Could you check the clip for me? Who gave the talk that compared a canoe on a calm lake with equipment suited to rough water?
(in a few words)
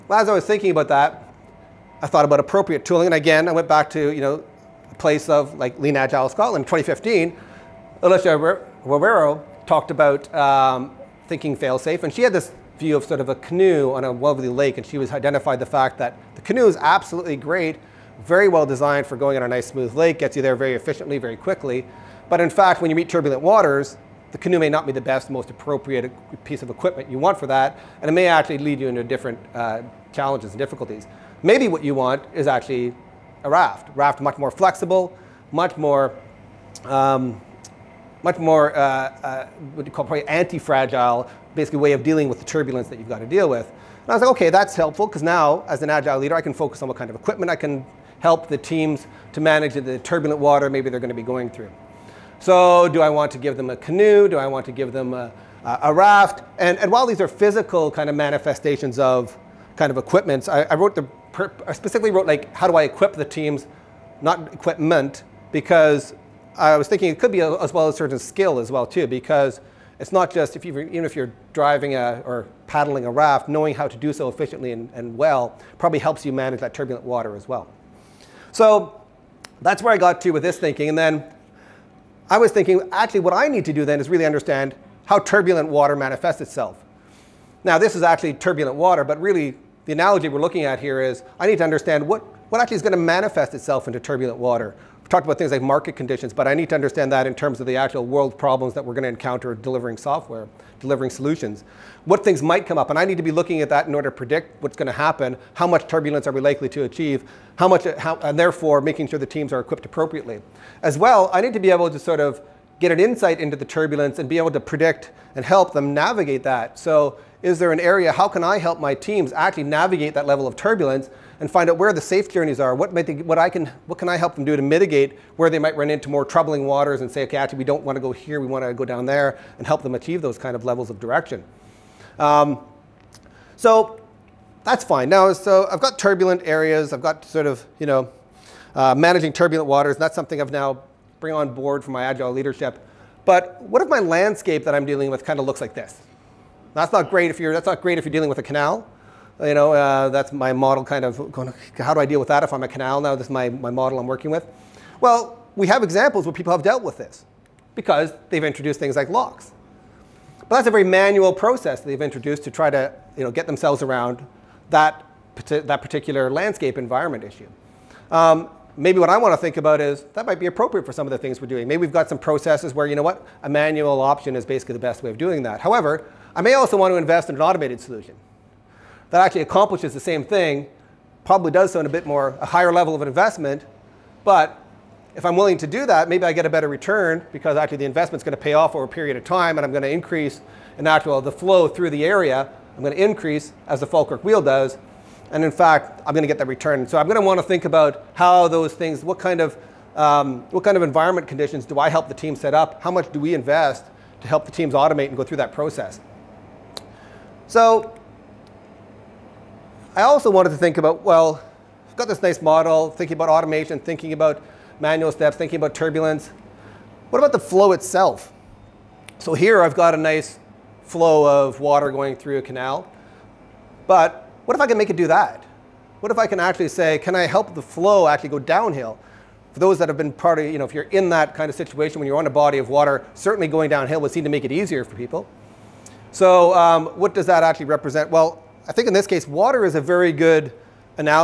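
Alicia Rivero.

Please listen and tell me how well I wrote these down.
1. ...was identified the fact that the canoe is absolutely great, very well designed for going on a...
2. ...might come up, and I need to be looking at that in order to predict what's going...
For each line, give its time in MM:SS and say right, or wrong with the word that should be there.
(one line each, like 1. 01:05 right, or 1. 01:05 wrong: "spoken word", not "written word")
1. 00:14 right
2. 01:42 right.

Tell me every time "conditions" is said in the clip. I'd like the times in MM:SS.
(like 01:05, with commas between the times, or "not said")
01:35, 03:21.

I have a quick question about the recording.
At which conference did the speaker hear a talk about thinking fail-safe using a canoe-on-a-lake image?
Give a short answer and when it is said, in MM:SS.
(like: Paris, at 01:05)
Lean Agile Scotland 2015, at 00:05.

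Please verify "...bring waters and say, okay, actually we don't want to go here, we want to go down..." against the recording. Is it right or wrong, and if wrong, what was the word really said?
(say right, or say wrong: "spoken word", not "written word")
wrong: "troubling", not "bring".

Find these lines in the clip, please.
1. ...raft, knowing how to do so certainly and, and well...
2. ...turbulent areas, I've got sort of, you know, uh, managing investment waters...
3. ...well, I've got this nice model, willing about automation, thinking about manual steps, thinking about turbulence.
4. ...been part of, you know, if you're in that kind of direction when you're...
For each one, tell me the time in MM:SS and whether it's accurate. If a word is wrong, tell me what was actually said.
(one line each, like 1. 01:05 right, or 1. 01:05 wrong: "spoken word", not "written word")
1. 01:13 wrong: "efficiently", not "certainly"
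2. 02:15 wrong: "turbulent", not "investment"
3. 03:31 wrong: "thinking", not "willing"
4. 03:49 wrong: "situation", not "direction".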